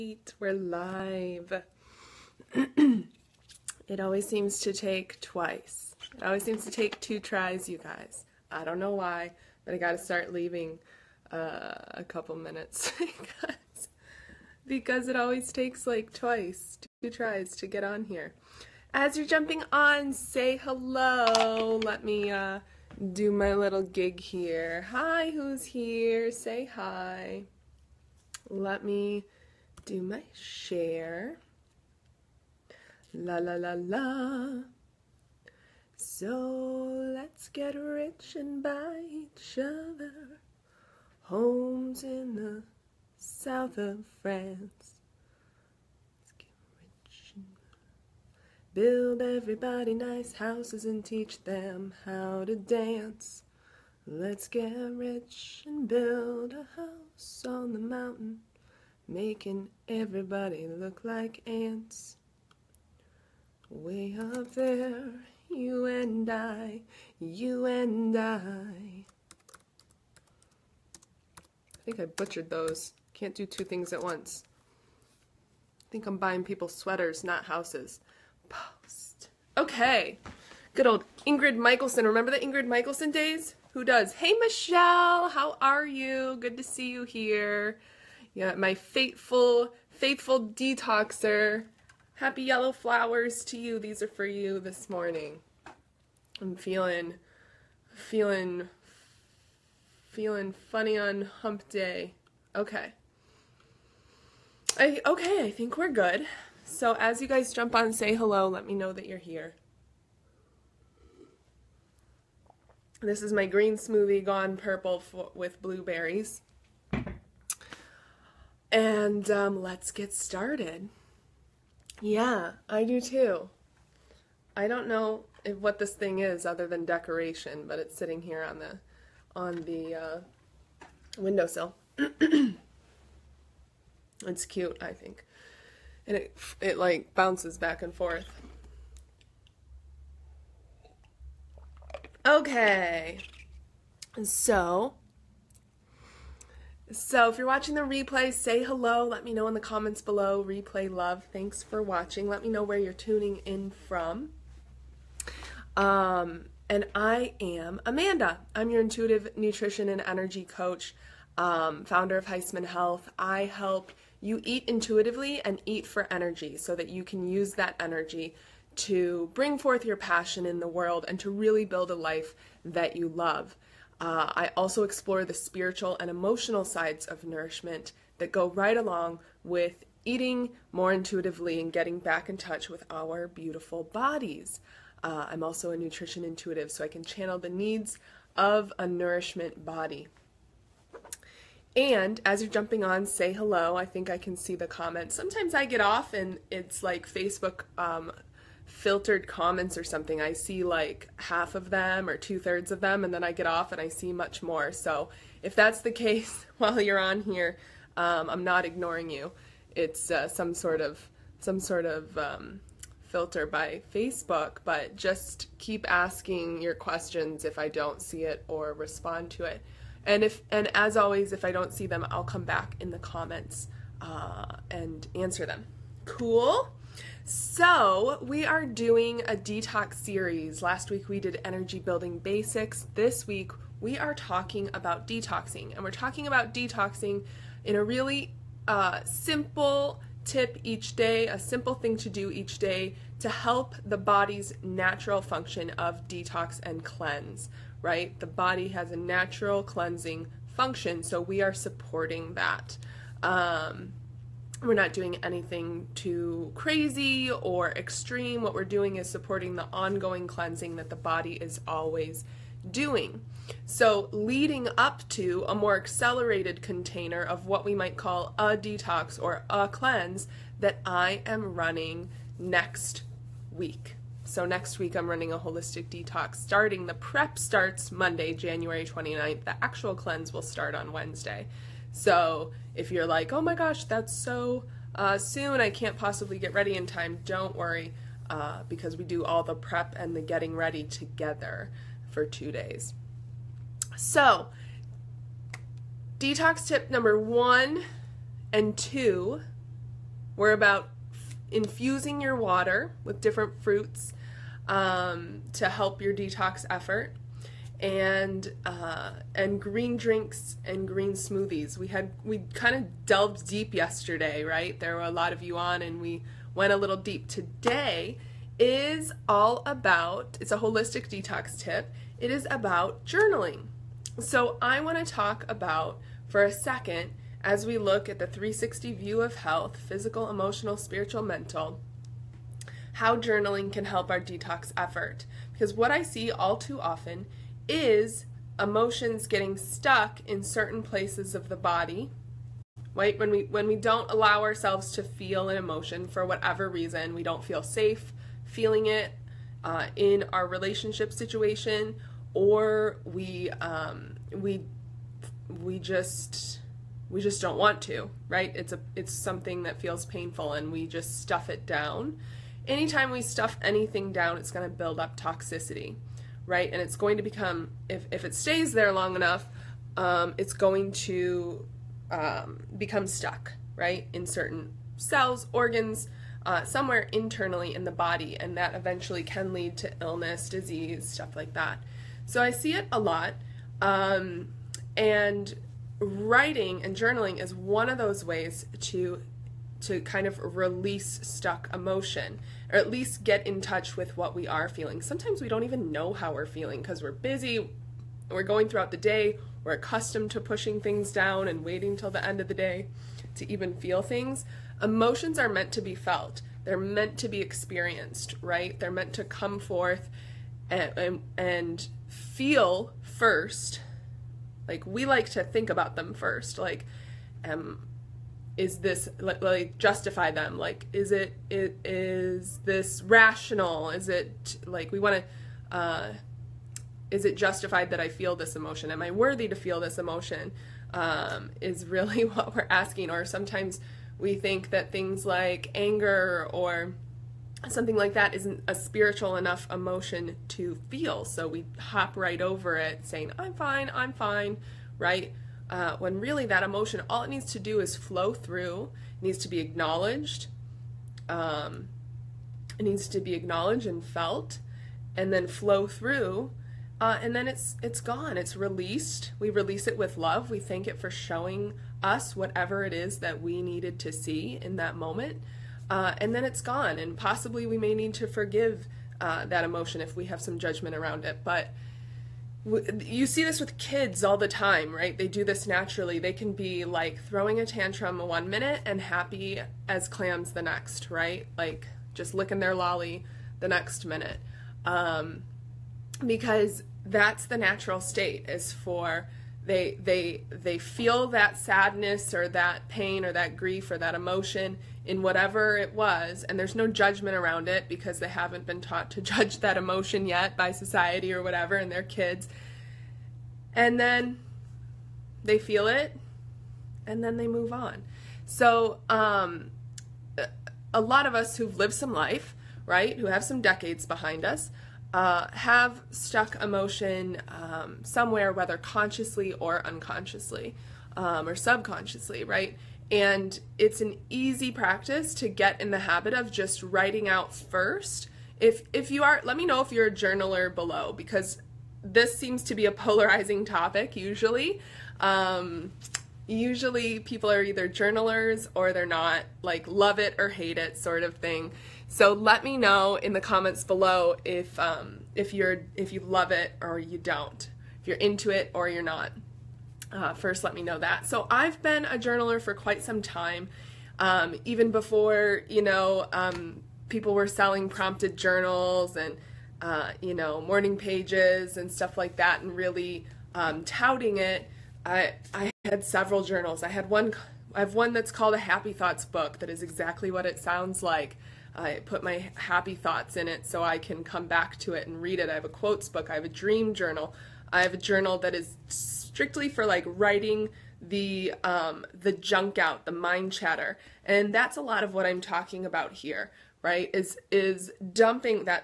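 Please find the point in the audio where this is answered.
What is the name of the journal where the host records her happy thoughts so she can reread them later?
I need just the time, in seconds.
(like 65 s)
568 s.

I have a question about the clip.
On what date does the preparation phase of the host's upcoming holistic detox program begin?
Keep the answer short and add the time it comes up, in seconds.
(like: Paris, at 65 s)
Monday, January 29th, at 277 s.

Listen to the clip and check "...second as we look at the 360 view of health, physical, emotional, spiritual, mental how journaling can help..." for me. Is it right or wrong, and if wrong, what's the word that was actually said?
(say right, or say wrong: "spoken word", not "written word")
right.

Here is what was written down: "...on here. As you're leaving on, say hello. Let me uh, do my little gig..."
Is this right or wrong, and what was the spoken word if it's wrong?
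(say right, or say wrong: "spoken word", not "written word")
wrong: "jumping", not "leaving".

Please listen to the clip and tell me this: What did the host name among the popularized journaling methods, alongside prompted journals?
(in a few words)
Morning pages.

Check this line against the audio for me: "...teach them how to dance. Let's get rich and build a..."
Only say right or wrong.
right.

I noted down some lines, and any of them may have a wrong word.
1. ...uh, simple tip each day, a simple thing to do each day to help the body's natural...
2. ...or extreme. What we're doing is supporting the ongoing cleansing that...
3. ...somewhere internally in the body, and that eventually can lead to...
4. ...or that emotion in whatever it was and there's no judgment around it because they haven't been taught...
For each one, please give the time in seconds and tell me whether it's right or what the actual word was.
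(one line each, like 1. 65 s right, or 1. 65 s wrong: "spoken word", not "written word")
1. 238 s right
2. 257 s right
3. 376 s right
4. 493 s right.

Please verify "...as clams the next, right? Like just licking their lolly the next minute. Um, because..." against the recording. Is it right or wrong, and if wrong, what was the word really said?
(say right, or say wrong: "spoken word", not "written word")
right.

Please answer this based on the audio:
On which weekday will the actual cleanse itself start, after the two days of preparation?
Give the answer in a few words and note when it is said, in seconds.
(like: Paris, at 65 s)
Wednesday, at 280 s.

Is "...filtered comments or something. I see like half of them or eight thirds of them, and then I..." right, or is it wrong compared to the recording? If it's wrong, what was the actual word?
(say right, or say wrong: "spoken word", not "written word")
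wrong: "two", not "eight".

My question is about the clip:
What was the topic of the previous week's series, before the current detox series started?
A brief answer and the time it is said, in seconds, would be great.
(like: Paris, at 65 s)
Energy building basics, at 231 s.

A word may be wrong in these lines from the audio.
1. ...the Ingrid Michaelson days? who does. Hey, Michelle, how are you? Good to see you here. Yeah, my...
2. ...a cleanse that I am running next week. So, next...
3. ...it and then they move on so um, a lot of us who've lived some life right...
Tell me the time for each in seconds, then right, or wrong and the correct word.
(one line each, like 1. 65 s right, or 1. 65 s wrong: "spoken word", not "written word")
1. 82 s right
2. 269 s right
3. 505 s right.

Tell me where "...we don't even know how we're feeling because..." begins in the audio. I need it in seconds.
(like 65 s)
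395 s.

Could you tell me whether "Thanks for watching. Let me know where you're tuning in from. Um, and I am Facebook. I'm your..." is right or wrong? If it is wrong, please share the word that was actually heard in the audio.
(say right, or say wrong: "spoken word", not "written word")
wrong: "Amanda", not "Facebook".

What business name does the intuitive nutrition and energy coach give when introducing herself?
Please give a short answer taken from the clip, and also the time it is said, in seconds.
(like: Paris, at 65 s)
Heisman Health, at 162 s.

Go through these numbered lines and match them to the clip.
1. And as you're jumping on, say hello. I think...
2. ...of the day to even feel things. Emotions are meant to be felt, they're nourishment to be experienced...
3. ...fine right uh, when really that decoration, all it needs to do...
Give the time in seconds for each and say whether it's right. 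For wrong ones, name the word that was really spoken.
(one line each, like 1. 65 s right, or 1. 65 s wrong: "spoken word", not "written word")
1. 191 s right
2. 402 s wrong: "meant", not "nourishment"
3. 444 s wrong: "emotion", not "decoration".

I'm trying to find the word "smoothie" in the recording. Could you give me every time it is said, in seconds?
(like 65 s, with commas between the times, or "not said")
113 s, 311 s.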